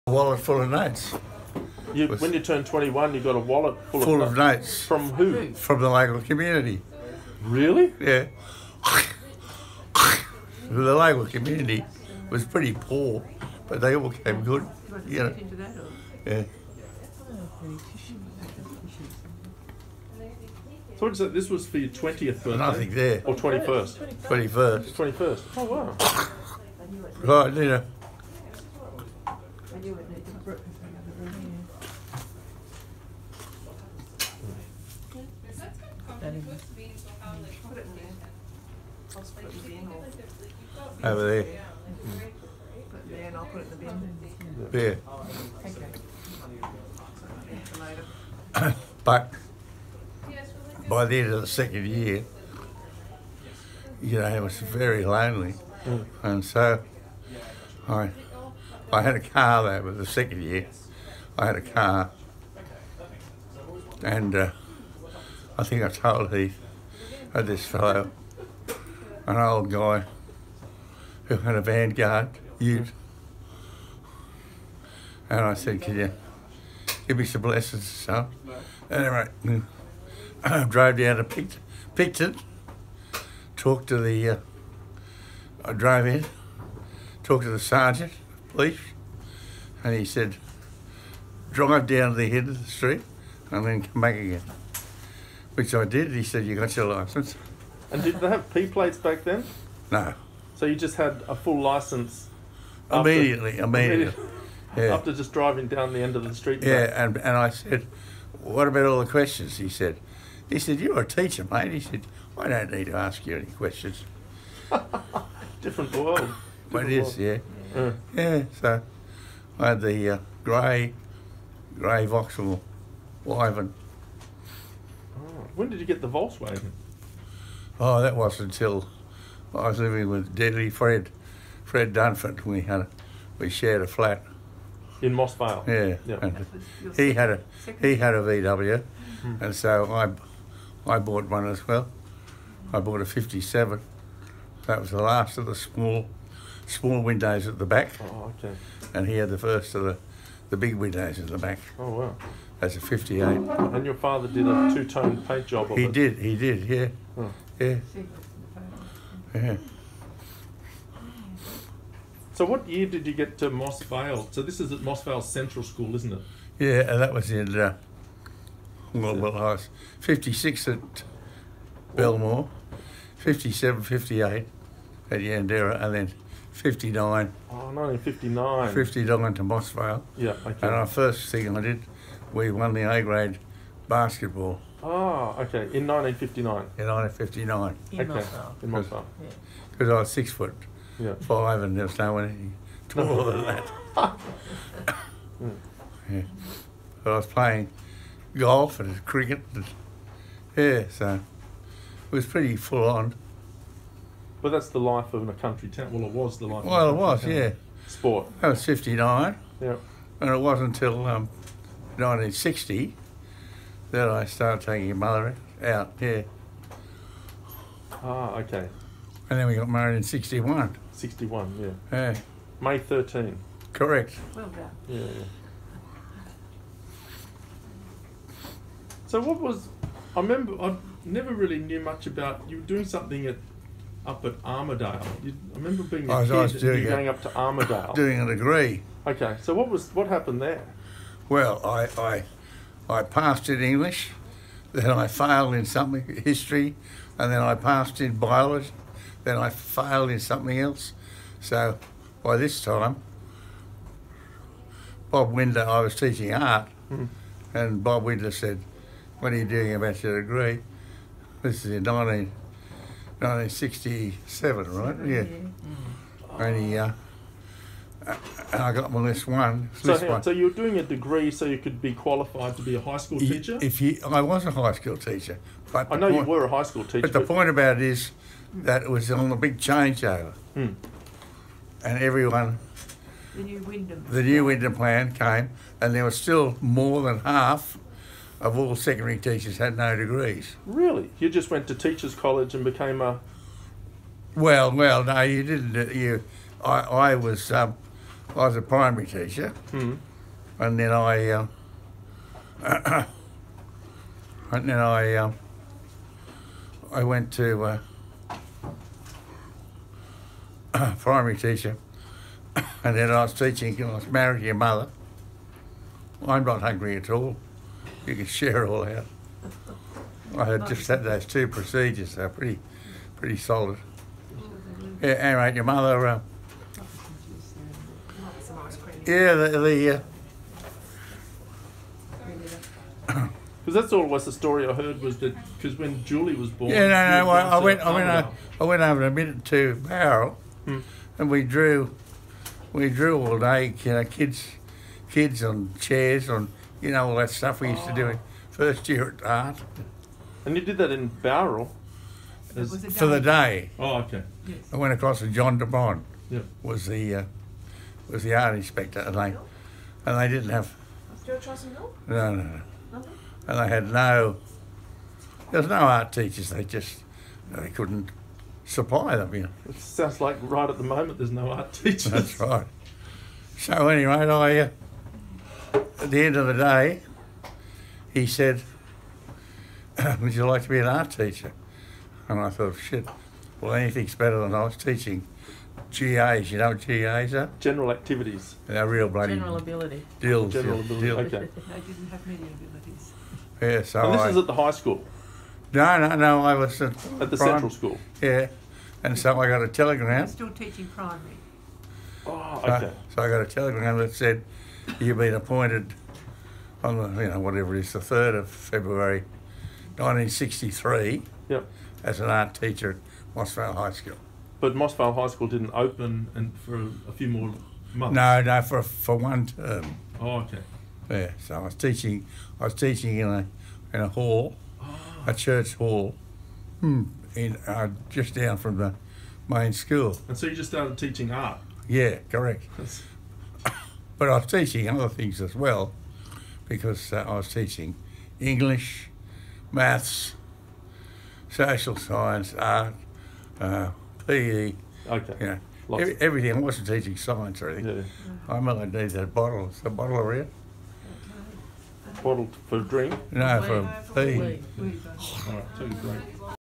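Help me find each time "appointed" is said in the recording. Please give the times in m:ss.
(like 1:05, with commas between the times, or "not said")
6:45.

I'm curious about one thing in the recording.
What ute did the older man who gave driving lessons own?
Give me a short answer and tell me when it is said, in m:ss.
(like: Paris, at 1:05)
Vanguard, at 1:11.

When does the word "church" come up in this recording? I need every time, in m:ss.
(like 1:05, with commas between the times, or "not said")
7:05.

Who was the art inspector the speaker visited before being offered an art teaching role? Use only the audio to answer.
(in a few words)
John DeBond.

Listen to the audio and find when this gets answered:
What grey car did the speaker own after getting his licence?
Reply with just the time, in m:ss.
2:02.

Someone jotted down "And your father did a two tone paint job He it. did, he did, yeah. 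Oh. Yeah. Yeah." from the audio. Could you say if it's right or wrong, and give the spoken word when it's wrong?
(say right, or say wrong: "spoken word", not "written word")
right.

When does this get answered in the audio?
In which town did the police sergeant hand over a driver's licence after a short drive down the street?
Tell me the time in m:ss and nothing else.
1:21.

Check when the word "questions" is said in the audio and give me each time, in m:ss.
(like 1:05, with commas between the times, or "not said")
1:49, 1:53.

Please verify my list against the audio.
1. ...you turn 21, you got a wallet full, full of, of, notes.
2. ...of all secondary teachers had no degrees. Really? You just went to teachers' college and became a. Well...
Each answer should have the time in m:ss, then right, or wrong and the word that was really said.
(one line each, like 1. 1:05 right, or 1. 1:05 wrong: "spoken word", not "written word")
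1. 0:02 right
2. 4:48 right.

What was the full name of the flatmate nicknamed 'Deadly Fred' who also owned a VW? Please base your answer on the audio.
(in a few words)
Fred Dunford.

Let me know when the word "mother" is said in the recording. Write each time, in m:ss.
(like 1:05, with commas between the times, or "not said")
3:34, 5:14, 5:25.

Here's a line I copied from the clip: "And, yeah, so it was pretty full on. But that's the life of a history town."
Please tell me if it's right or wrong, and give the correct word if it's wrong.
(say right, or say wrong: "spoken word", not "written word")
wrong: "country", not "history".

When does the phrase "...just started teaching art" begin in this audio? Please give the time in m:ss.
7:10.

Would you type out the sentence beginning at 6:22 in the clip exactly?
And I thought, shit, well, anything's better than I was teaching GAs.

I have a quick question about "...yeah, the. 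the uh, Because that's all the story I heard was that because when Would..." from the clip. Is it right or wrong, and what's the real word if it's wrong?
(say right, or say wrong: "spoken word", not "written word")
wrong: "Julie", not "Would".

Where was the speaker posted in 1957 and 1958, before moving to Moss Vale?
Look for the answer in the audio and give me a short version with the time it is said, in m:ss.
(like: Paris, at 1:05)
Yanderra, at 2:55.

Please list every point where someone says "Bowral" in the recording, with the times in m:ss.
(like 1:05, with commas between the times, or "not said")
5:39, 5:51.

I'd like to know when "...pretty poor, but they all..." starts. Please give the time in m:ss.
0:12.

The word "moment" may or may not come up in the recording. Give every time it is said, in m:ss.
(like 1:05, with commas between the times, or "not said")
6:10.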